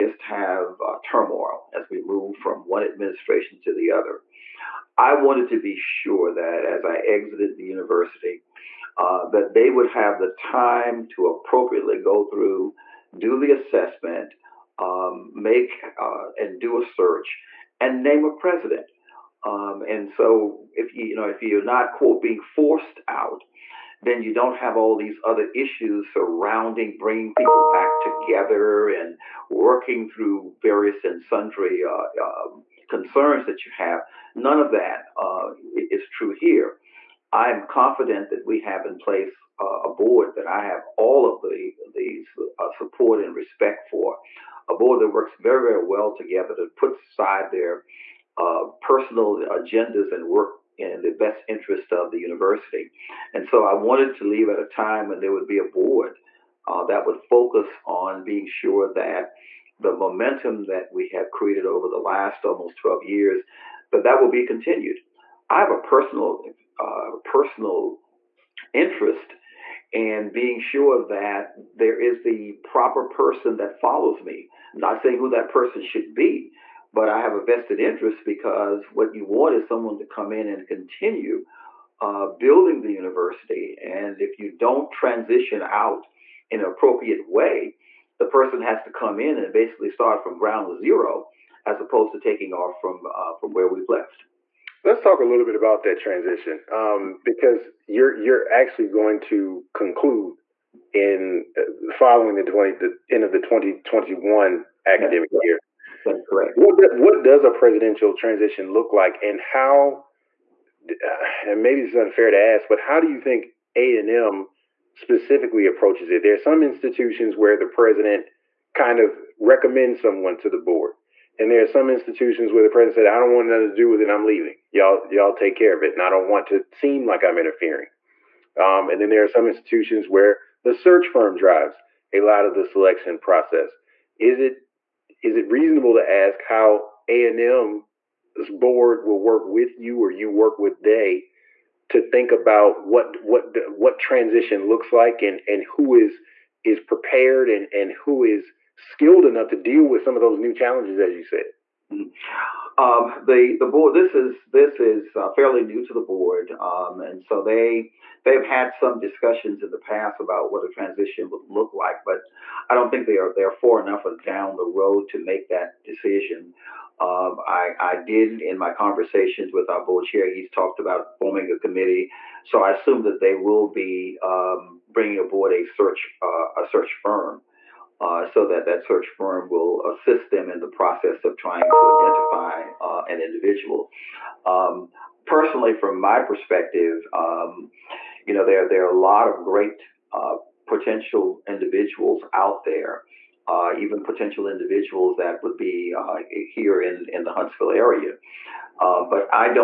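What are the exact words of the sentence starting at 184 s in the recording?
Um, personally, from my perspective, um, you know, there, there are a lot of great uh, potential individuals out there.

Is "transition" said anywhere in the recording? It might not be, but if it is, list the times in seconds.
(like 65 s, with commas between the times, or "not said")
84 s, 95 s, 108 s, 143 s, 160 s.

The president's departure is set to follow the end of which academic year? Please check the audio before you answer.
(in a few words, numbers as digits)
2021.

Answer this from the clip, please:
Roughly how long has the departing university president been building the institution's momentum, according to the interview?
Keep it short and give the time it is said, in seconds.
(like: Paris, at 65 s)
almost 12 years, at 62 s.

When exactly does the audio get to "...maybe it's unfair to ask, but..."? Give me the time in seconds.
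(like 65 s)
111 s.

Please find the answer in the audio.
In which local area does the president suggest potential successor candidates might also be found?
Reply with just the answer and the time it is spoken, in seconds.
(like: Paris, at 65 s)
Huntsville, at 197 s.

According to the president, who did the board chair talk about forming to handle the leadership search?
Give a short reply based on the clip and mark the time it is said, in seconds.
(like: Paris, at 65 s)
a committee, at 171 s.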